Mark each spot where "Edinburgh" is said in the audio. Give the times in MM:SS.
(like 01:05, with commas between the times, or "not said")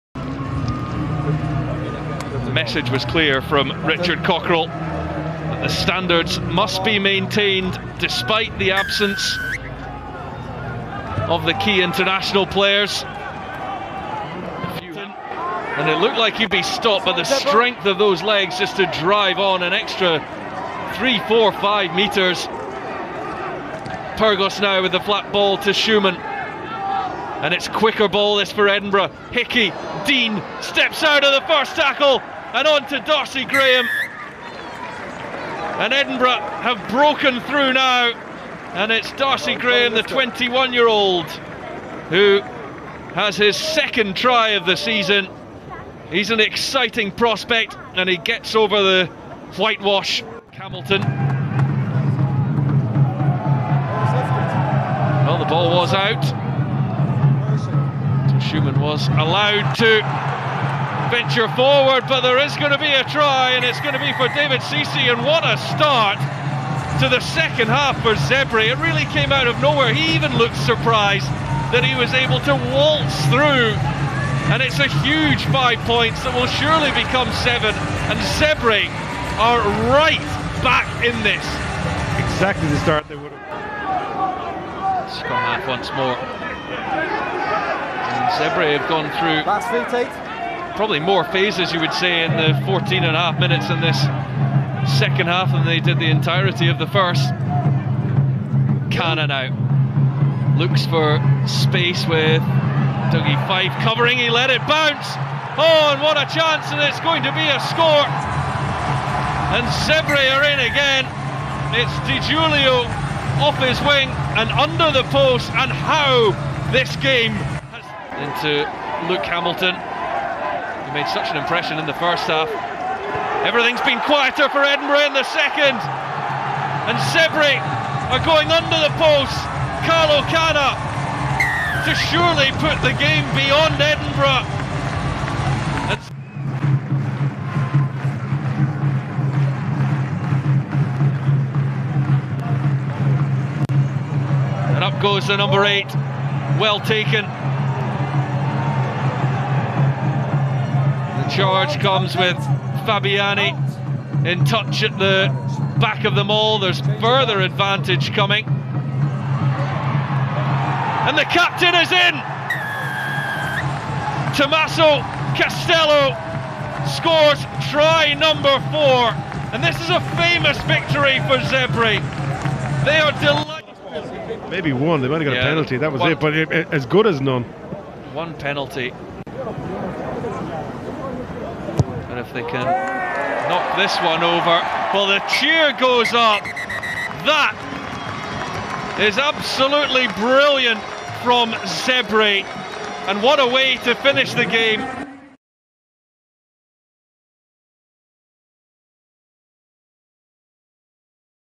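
00:28, 00:35, 02:04, 02:13.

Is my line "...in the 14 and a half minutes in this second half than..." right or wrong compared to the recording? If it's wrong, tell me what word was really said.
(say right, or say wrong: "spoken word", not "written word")
right.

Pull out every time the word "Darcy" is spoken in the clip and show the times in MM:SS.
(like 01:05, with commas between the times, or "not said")
00:33, 00:39.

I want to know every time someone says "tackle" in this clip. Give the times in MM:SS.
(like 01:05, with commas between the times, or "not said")
00:31.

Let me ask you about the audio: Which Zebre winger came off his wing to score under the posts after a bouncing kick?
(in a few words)
Di Giulio.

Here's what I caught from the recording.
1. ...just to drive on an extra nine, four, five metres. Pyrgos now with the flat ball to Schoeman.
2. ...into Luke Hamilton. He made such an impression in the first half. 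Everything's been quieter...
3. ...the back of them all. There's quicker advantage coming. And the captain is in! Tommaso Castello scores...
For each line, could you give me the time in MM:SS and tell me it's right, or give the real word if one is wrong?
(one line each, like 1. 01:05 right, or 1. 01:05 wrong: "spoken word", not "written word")
1. 00:18 wrong: "three", not "nine"
2. 01:58 right
3. 02:34 wrong: "further", not "quicker".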